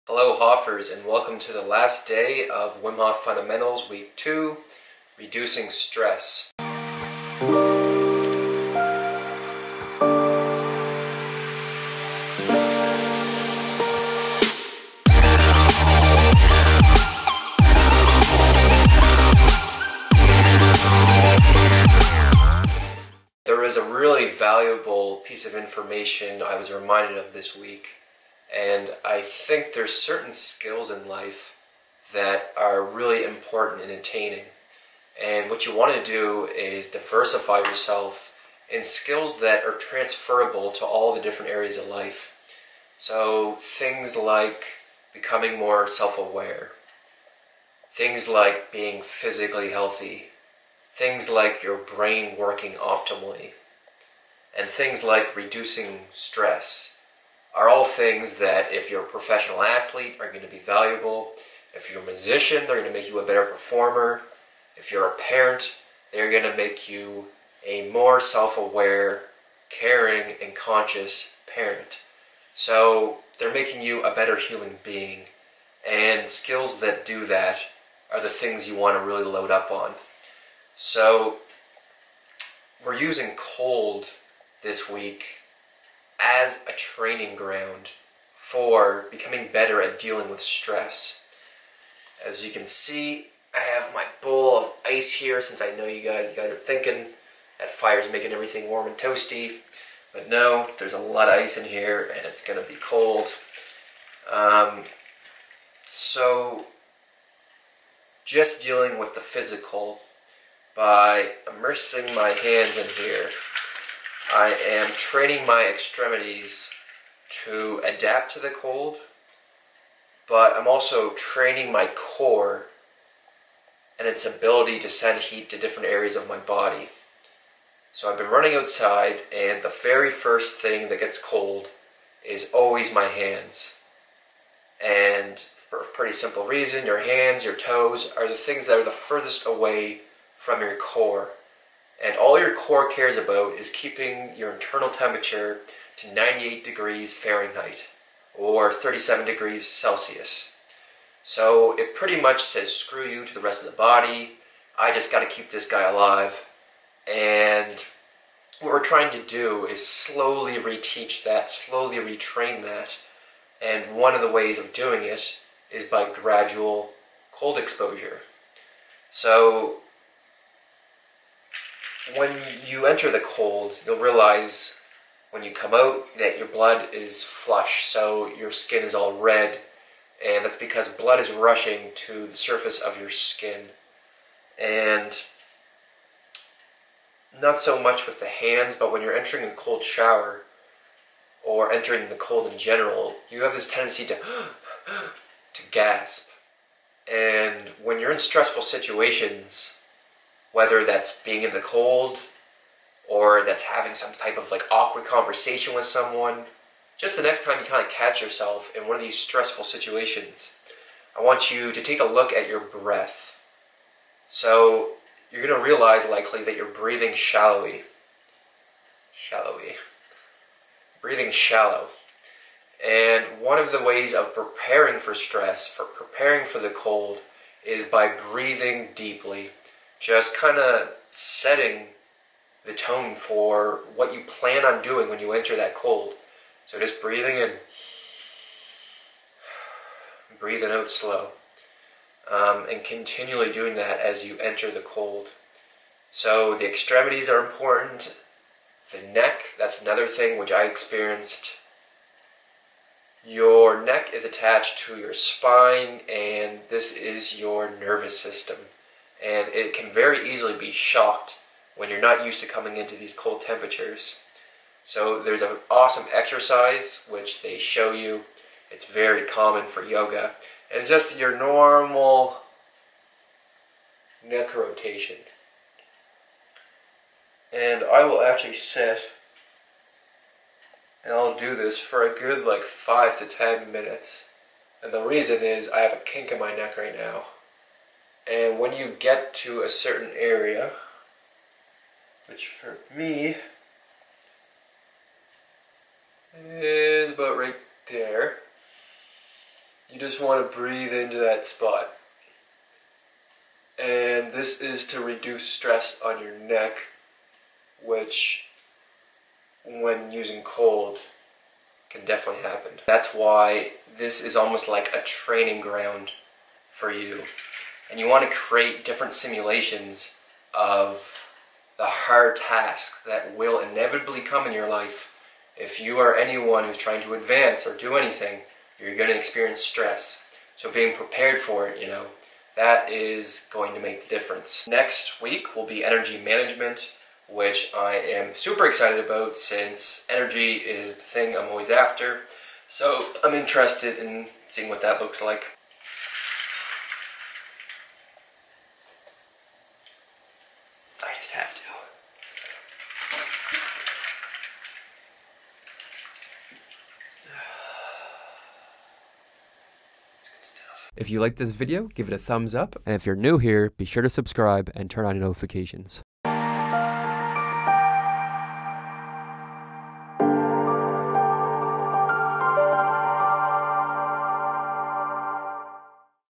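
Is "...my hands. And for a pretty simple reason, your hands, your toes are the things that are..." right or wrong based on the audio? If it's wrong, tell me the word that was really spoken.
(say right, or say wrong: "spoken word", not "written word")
right.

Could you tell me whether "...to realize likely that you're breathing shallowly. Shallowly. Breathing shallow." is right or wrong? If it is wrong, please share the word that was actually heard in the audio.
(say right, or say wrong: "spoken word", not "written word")
right.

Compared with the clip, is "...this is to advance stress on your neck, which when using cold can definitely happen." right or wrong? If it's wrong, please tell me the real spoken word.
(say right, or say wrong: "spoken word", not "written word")
wrong: "reduce", not "advance".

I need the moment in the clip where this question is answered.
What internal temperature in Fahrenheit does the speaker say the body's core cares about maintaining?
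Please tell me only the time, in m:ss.
2:26.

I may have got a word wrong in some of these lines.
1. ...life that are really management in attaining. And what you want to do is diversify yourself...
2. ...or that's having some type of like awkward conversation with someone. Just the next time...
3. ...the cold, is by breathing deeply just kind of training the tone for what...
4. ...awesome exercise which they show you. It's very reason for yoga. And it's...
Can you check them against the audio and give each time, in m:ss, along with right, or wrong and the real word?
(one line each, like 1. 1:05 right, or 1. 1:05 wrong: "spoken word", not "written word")
1. 0:31 wrong: "important", not "management"
2. 3:23 right
3. 3:46 wrong: "setting", not "training"
4. 4:25 wrong: "common", not "reason".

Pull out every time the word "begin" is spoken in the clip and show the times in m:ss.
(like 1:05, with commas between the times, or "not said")
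not said.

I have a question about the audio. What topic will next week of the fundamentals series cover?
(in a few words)
Energy management.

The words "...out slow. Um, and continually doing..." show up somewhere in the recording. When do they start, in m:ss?
4:00.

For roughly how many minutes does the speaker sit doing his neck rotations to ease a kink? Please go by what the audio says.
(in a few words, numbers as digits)
5 to 10 minutes.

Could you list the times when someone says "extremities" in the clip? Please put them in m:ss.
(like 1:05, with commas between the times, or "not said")
1:55, 4:06.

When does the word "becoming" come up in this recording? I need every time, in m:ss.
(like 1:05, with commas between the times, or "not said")
0:45, 1:29.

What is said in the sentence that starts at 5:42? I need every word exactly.
So I'm interested in seeing what that looks like.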